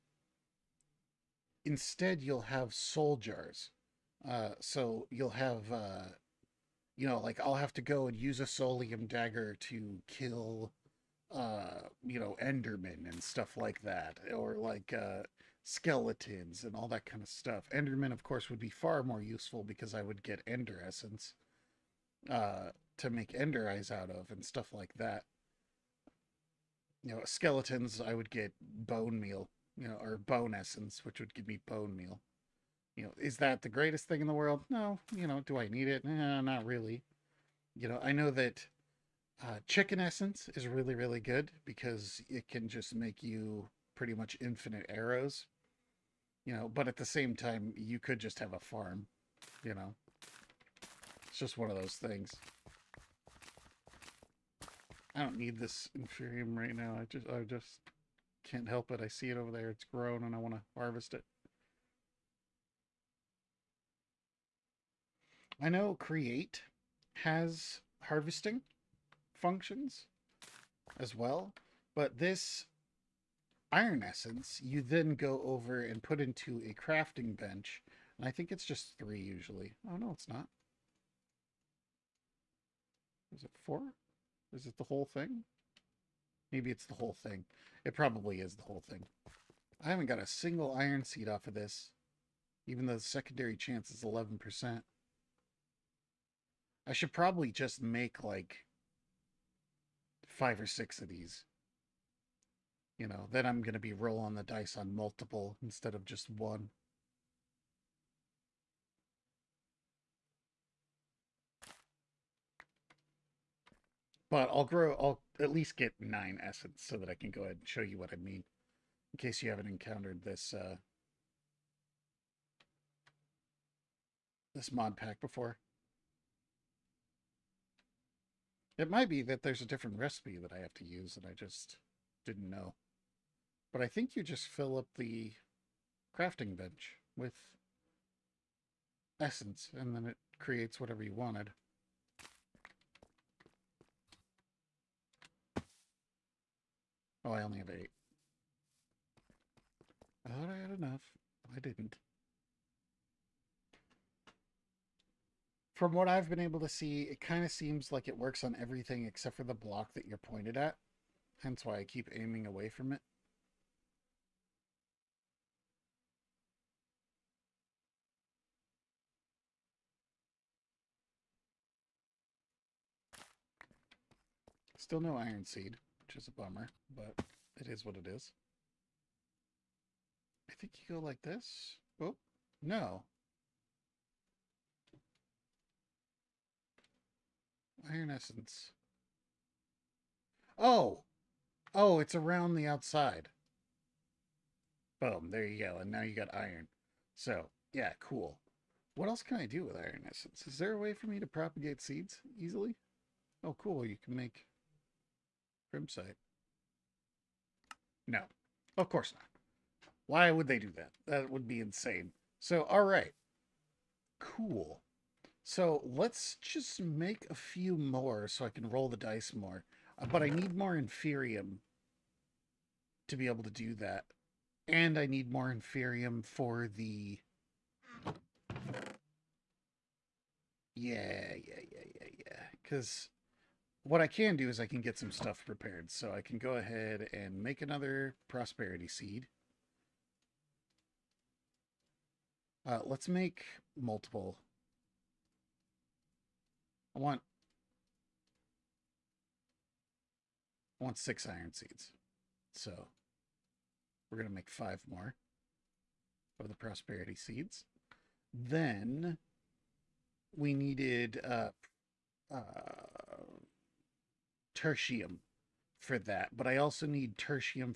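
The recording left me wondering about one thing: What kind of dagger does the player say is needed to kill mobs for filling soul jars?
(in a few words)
Soulium dagger.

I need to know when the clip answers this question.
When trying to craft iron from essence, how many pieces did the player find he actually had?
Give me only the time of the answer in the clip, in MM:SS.
02:27.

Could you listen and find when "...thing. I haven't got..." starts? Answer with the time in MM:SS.
01:28.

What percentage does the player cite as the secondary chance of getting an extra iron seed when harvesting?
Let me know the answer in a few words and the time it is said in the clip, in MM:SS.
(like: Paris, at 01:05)
11%, at 01:34.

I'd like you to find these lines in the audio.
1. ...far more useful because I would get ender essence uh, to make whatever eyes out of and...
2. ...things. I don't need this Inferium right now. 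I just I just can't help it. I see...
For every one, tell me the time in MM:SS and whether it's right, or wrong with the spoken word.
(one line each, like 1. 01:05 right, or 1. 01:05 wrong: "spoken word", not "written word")
1. 00:18 wrong: "ender", not "whatever"
2. 00:51 right.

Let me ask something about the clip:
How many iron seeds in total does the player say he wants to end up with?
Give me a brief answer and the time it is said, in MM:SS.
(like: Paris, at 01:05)
6, at 04:10.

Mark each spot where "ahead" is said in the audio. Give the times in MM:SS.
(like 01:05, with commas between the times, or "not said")
01:57, 03:56.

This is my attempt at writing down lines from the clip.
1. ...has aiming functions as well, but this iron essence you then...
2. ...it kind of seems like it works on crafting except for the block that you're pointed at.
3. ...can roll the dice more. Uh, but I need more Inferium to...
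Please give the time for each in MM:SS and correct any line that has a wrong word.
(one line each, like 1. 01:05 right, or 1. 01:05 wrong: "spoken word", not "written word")
1. 01:07 wrong: "harvesting", not "aiming"
2. 02:37 wrong: "everything", not "crafting"
3. 03:38 right.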